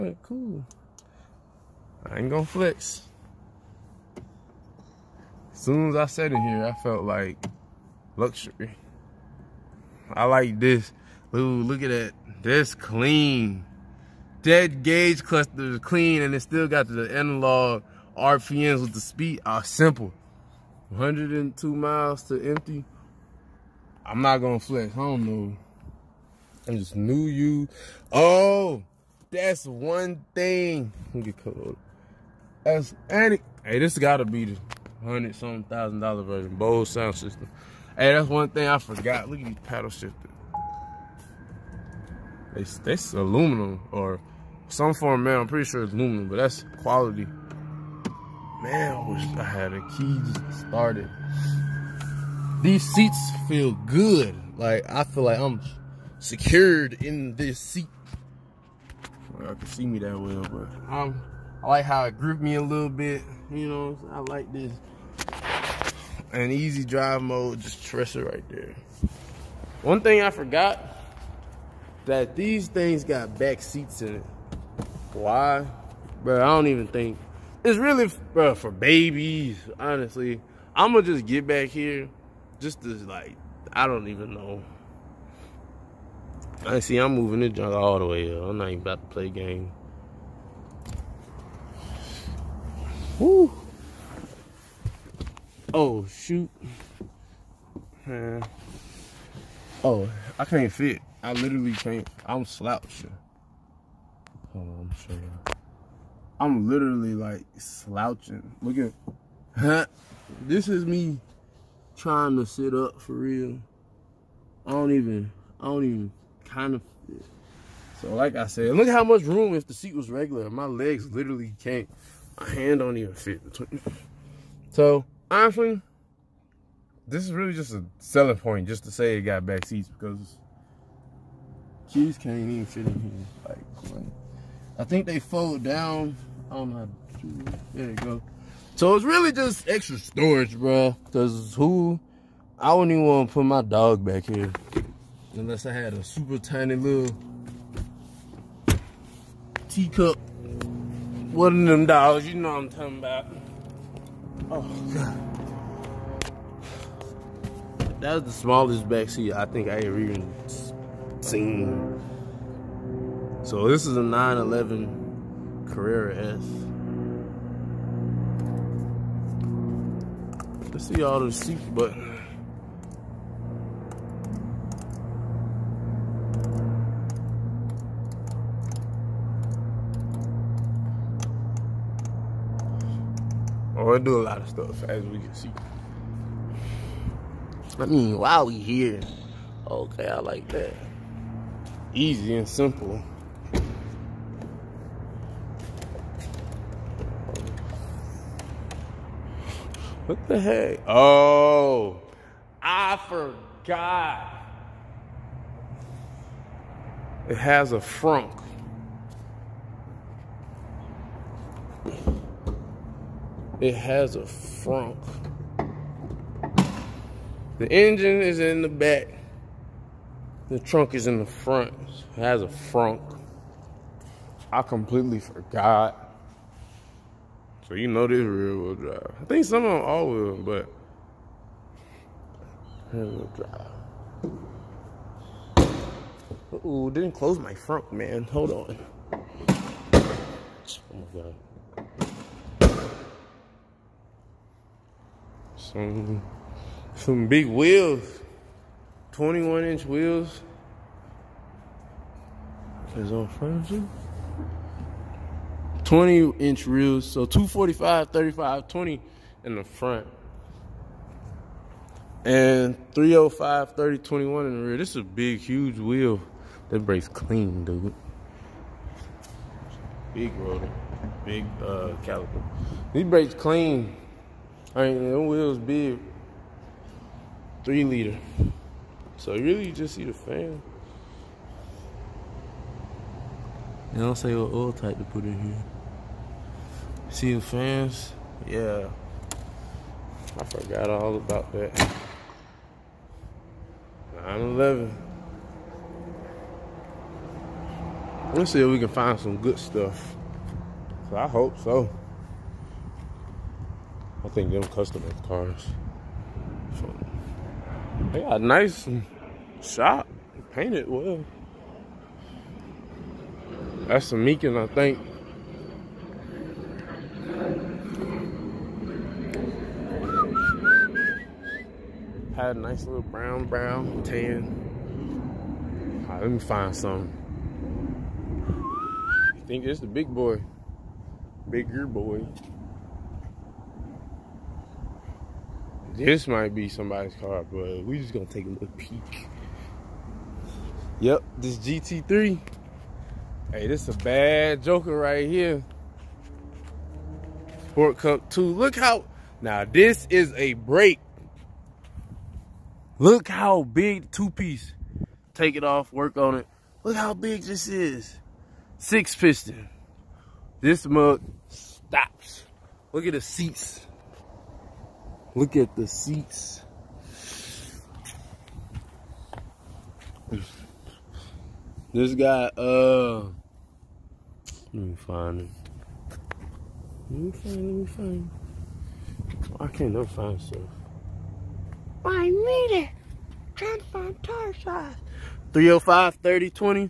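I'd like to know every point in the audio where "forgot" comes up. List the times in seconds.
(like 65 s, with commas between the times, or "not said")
38 s, 70 s, 203 s, 225 s, 290 s.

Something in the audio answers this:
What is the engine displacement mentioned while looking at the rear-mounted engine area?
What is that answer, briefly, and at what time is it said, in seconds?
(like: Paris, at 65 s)
3 liter, at 277 s.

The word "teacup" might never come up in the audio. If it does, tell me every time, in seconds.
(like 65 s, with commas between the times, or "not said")
149 s.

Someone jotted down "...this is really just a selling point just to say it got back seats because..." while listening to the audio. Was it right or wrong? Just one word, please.
right.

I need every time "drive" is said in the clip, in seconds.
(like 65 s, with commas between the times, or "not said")
66 s, 228 s, 235 s.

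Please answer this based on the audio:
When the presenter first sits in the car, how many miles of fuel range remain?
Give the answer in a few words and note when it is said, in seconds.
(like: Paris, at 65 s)
102, at 20 s.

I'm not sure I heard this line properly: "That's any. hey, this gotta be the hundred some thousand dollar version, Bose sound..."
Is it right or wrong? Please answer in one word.
right.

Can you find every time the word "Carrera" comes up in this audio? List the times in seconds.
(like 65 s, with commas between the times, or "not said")
165 s.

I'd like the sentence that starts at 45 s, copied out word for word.
I'm pretty sure it's aluminum, but that's quality.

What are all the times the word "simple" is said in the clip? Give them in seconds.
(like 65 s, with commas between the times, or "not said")
19 s, 192 s.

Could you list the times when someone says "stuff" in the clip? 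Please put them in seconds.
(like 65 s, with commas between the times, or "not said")
184 s, 299 s, 380 s.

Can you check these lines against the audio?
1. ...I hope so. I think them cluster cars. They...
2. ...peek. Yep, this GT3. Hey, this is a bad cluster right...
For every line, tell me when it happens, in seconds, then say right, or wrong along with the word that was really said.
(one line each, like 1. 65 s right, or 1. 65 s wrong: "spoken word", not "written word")
1. 301 s wrong: "customer", not "cluster"
2. 338 s wrong: "joker", not "cluster".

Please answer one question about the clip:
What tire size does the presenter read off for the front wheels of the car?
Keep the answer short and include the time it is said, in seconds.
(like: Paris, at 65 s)
245/35/20, at 257 s.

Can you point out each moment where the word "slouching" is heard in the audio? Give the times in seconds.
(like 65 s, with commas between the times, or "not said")
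102 s, 107 s.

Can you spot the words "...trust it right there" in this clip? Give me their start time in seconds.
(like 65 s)
67 s.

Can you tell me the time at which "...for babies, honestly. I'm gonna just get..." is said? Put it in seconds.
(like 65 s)
78 s.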